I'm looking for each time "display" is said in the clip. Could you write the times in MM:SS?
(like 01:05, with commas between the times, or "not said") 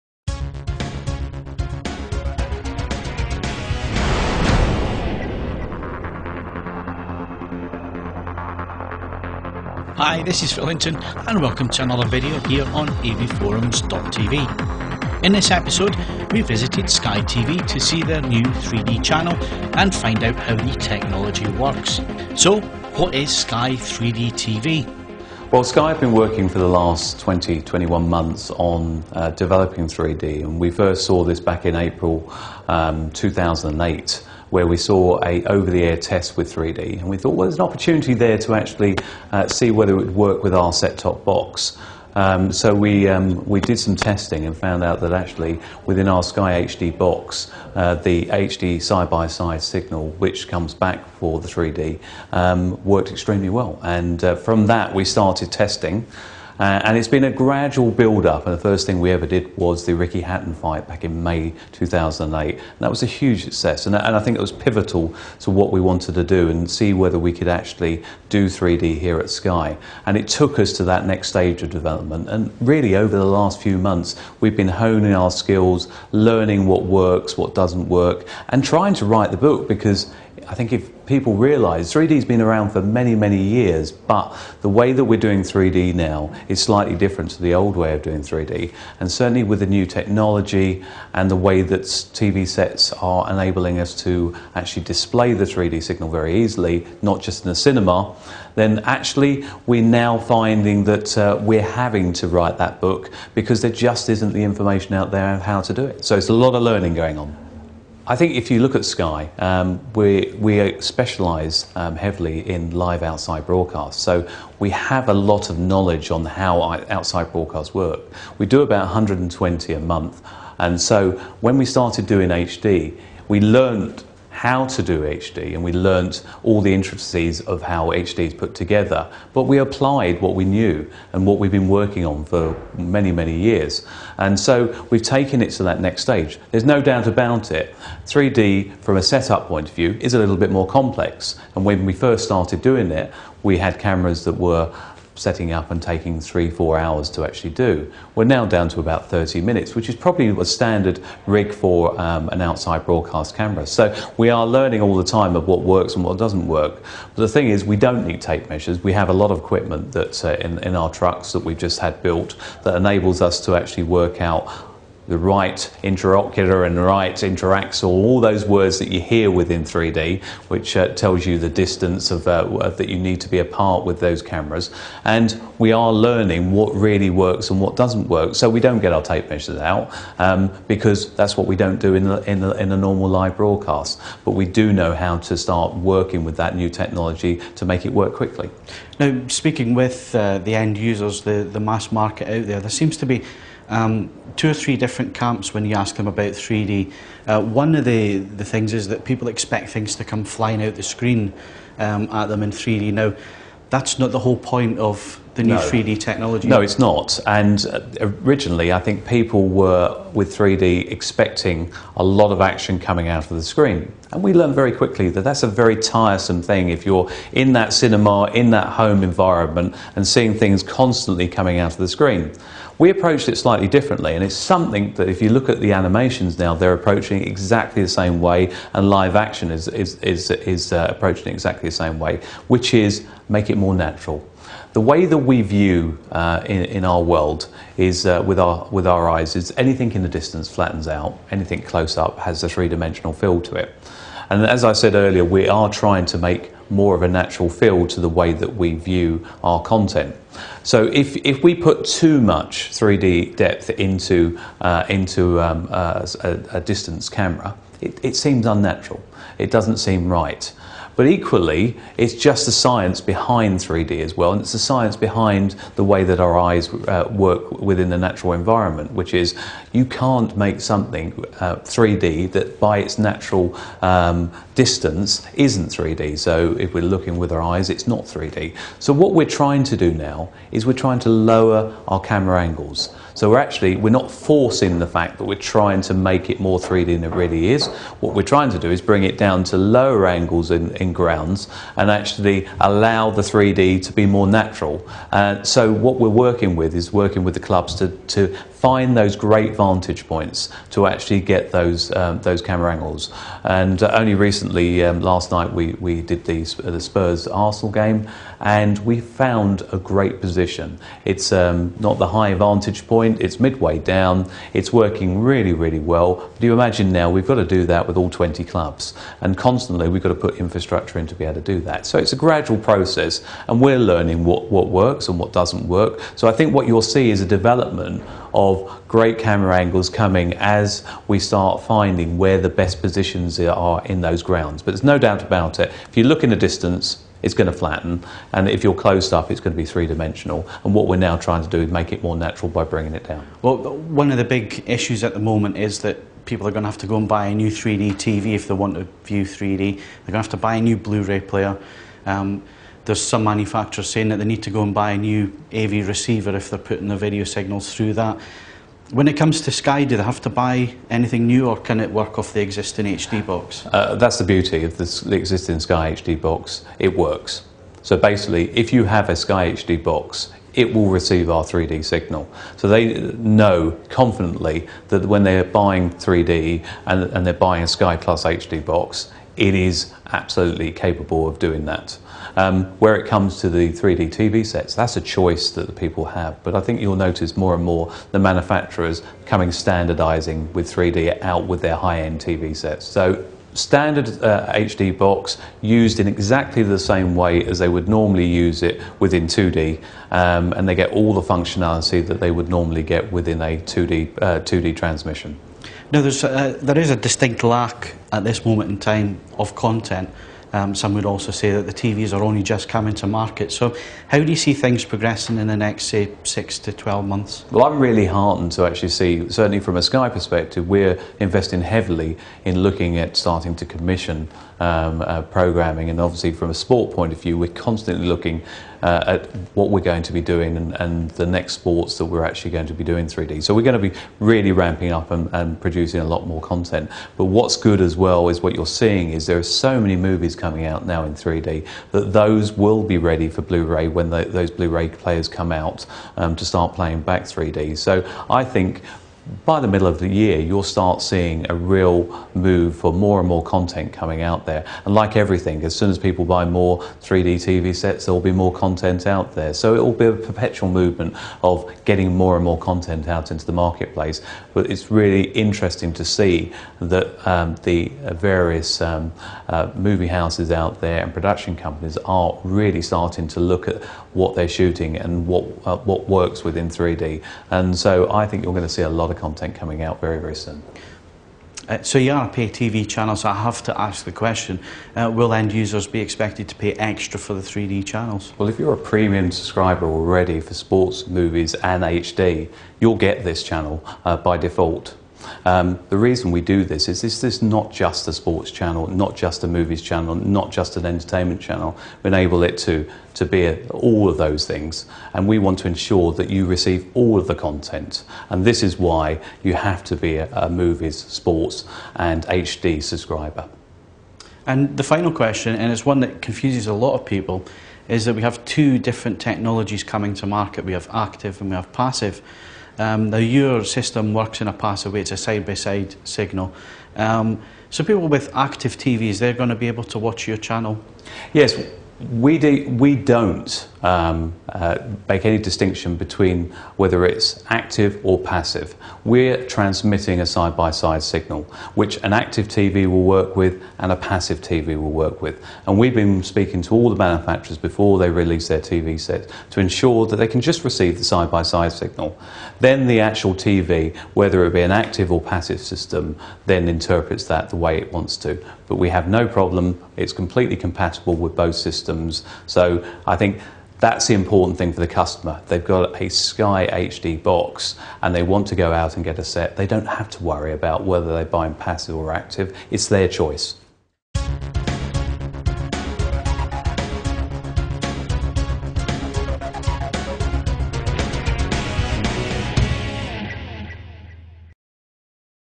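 01:34.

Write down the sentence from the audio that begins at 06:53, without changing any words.
So, how do you see things progressing in the next, say, six to 12 months?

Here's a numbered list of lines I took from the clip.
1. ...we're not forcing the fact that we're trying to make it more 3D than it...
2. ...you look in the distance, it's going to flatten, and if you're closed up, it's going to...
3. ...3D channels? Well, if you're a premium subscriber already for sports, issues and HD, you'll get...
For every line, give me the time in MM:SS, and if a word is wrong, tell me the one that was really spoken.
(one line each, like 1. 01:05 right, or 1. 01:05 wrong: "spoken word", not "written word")
1. 04:43 right
2. 05:35 right
3. 08:07 wrong: "movies", not "issues".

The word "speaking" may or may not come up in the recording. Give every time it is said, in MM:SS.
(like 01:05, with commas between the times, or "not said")
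03:09, 09:06.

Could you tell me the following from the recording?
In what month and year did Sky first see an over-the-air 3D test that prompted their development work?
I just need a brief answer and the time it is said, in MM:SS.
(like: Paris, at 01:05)
April 2008, at 00:31.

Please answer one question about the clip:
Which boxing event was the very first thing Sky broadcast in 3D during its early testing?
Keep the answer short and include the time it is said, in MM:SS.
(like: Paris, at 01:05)
Ricky Hatton fight, at 00:59.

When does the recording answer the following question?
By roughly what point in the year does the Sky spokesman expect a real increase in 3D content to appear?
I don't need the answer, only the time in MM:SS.
07:29.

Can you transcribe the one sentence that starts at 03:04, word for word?
But we do know how to start working with that new technology to make it work quickly.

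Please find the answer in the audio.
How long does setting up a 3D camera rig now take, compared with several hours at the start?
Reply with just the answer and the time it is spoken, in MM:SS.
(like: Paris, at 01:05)
30 minutes, at 02:29.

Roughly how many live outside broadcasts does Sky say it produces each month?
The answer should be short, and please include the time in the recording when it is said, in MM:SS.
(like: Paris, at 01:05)
120, at 01:58.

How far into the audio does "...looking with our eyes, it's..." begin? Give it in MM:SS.
04:36.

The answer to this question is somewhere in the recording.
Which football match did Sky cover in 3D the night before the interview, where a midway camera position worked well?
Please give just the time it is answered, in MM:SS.
05:06.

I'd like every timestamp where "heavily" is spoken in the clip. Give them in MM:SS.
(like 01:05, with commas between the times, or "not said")
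01:51, 07:01.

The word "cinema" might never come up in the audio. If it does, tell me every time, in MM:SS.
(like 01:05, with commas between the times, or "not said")
01:37, 03:37.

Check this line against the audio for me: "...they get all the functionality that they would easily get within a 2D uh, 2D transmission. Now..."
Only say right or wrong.
wrong.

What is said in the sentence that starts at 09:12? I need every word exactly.
Then the actual TV, whether it be an active or passive system, then interprets that the way it wants to.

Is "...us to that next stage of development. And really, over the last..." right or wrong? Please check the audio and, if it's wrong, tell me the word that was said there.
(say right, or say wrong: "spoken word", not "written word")
right.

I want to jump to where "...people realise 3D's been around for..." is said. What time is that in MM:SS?
01:21.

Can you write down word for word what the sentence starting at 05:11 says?
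It's um, not the high vantage point; it's midway down.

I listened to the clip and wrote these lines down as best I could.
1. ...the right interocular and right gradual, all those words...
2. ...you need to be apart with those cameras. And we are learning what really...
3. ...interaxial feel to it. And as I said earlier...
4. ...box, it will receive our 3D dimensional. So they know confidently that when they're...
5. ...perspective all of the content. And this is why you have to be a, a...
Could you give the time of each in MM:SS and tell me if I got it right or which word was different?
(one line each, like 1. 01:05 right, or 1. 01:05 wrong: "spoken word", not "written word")
1. 02:45 wrong: "interaxial", not "gradual"
2. 02:52 right
3. 04:02 wrong: "dimensional", not "interaxial"
4. 06:09 wrong: "signal", not "dimensional"
5. 08:26 wrong: "receive", not "perspective".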